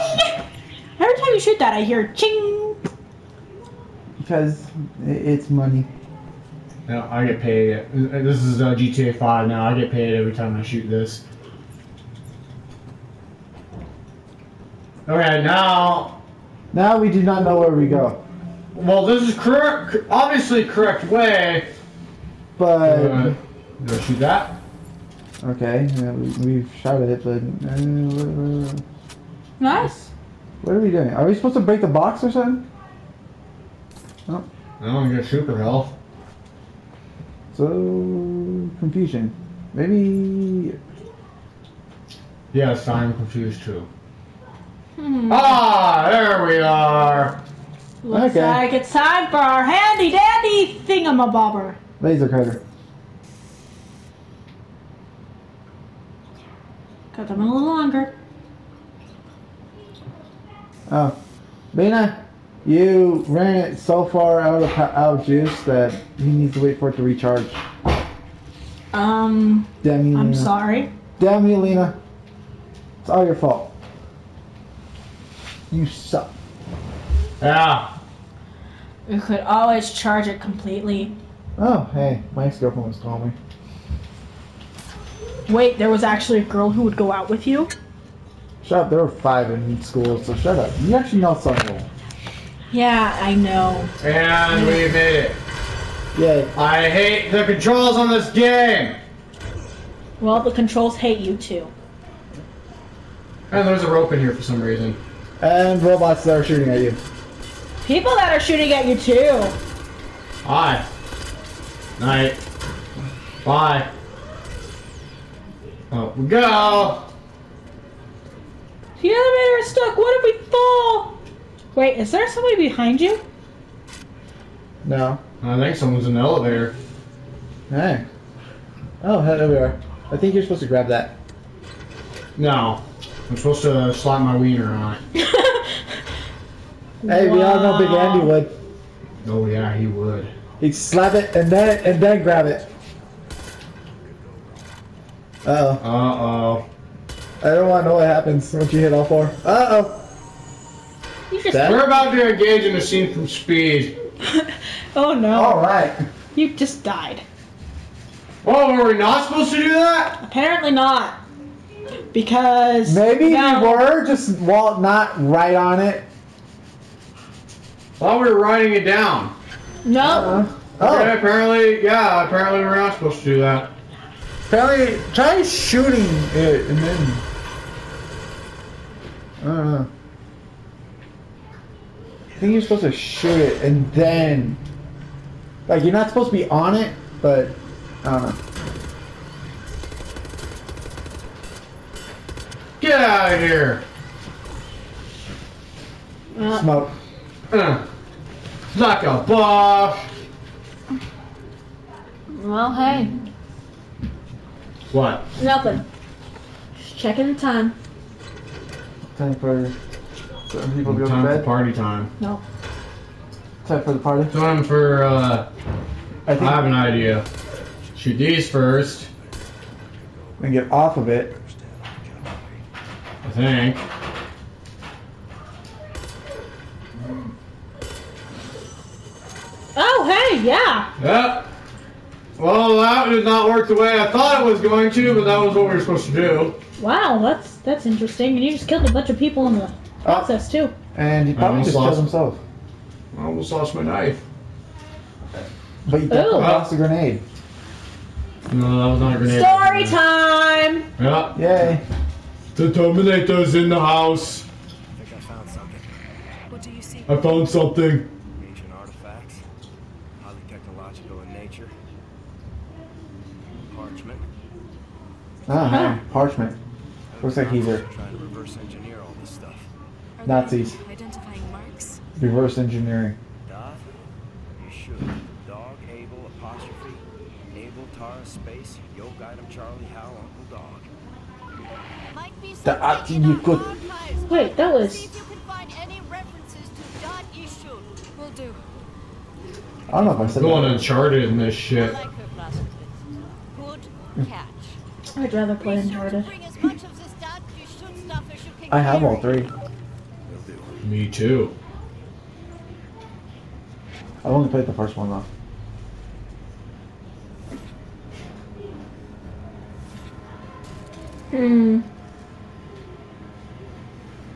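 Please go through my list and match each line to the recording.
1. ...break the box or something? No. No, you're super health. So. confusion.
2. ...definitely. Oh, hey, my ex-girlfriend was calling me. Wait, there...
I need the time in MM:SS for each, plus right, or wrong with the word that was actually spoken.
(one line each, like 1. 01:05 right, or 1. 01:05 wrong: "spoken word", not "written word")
1. 00:31 right
2. 01:20 wrong: "completely", not "definitely".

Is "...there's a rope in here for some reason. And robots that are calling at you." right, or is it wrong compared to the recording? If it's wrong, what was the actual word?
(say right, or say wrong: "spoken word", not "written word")
wrong: "shooting", not "calling".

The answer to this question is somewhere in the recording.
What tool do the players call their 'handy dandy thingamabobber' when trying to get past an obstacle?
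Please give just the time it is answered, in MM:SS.
00:51.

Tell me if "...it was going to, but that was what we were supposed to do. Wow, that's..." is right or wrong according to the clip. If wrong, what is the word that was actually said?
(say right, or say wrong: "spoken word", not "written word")
right.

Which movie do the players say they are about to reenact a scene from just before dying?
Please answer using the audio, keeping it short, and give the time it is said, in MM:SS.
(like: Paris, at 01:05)
Speed, at 02:33.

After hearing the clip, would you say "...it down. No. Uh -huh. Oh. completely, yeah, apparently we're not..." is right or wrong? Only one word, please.
wrong.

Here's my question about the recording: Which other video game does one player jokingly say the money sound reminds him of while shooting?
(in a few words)
GTA 5.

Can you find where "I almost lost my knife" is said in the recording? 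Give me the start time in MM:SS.
04:03.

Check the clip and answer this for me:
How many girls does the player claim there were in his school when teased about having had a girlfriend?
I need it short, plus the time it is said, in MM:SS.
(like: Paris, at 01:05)
5, at 01:29.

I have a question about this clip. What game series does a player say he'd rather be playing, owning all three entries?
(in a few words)
Uncharted.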